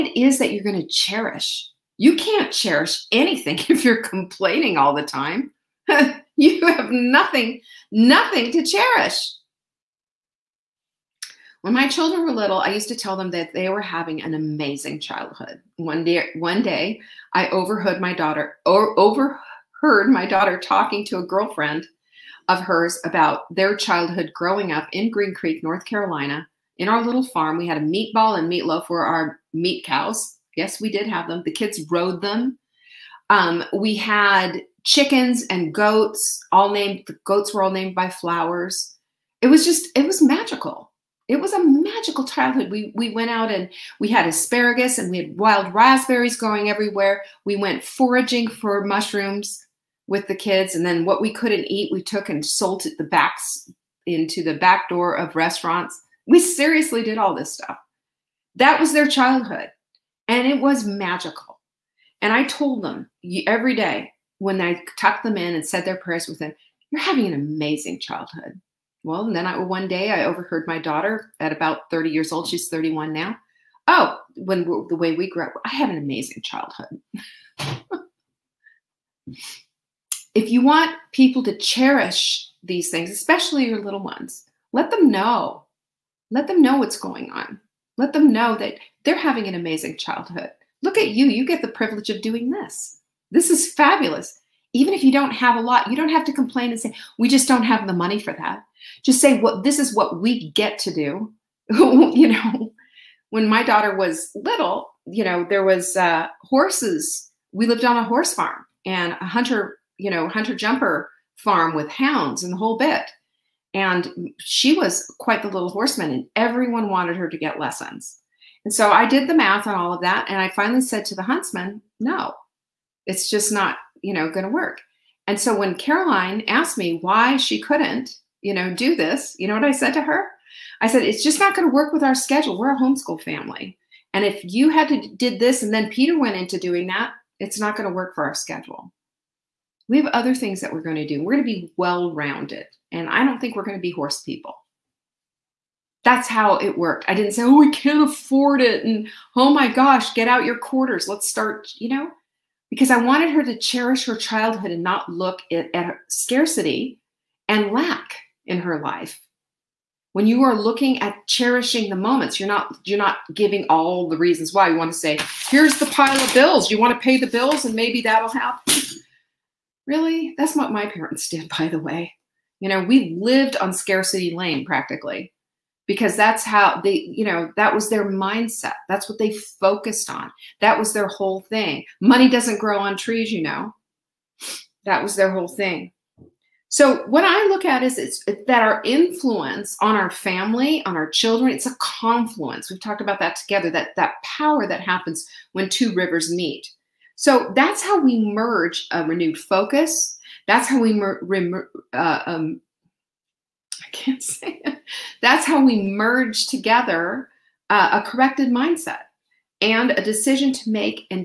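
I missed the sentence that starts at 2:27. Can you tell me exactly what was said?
I didn't say, oh, we can't afford it.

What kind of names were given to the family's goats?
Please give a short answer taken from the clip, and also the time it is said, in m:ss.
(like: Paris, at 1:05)
Flowers, at 0:38.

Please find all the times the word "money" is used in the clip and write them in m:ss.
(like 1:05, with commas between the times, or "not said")
1:37, 3:01.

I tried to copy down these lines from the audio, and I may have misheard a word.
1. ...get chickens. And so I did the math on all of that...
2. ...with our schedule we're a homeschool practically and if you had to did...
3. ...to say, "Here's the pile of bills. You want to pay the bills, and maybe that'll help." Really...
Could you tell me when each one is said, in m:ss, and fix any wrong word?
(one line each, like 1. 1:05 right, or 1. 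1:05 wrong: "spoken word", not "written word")
1. 1:57 wrong: "lessons", not "chickens"
2. 2:11 wrong: "family", not "practically"
3. 2:44 right.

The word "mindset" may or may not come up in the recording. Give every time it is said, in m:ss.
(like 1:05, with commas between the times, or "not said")
2:58, 3:28.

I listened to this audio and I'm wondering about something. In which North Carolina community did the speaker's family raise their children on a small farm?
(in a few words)
Green Creek.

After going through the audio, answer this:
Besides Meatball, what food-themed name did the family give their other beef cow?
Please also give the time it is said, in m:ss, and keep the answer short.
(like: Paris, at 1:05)
Meatloaf, at 0:28.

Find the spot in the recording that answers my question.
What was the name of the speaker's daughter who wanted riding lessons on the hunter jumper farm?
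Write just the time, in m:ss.
2:05.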